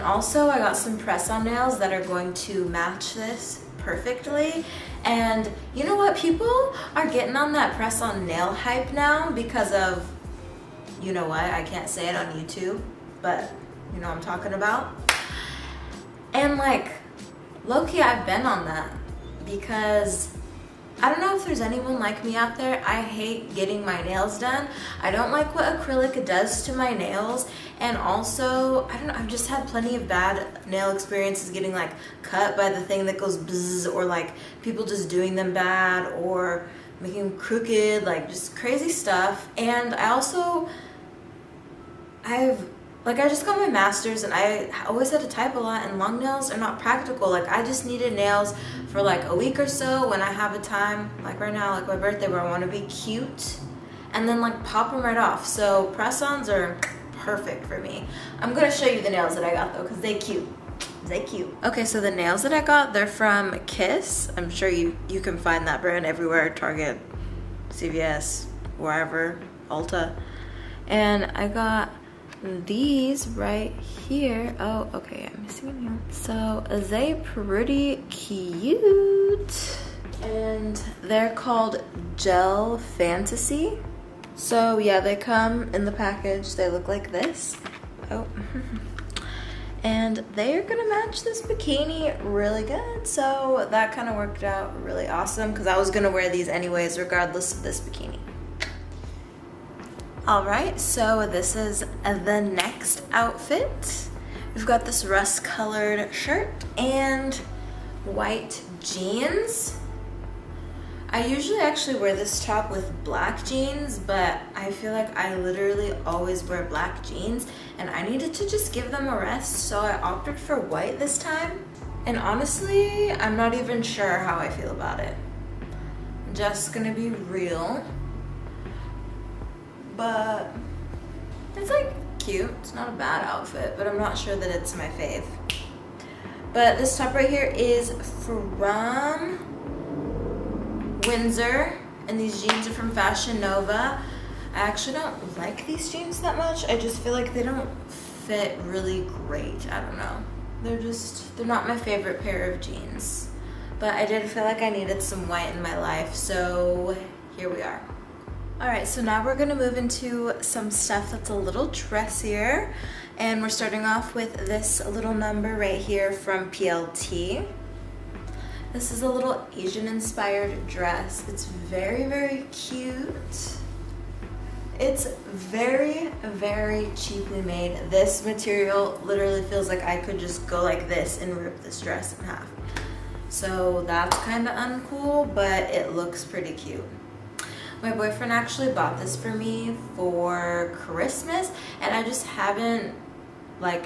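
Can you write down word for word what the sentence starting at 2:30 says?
They're just, they're not my favorite pair of jeans.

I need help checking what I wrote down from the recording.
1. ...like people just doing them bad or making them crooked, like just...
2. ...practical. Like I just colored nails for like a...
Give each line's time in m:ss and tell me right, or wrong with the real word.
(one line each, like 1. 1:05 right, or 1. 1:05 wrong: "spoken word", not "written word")
1. 0:34 right
2. 0:46 wrong: "needed", not "colored".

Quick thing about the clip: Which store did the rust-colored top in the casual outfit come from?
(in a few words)
Windsor.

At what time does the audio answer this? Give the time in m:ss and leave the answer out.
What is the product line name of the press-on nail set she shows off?
1:22.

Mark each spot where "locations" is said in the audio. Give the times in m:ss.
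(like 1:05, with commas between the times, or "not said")
not said.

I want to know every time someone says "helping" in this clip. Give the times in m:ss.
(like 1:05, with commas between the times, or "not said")
not said.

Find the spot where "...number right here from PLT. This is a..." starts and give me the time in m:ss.
2:45.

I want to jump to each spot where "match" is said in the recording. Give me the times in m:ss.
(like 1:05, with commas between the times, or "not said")
0:02, 1:30.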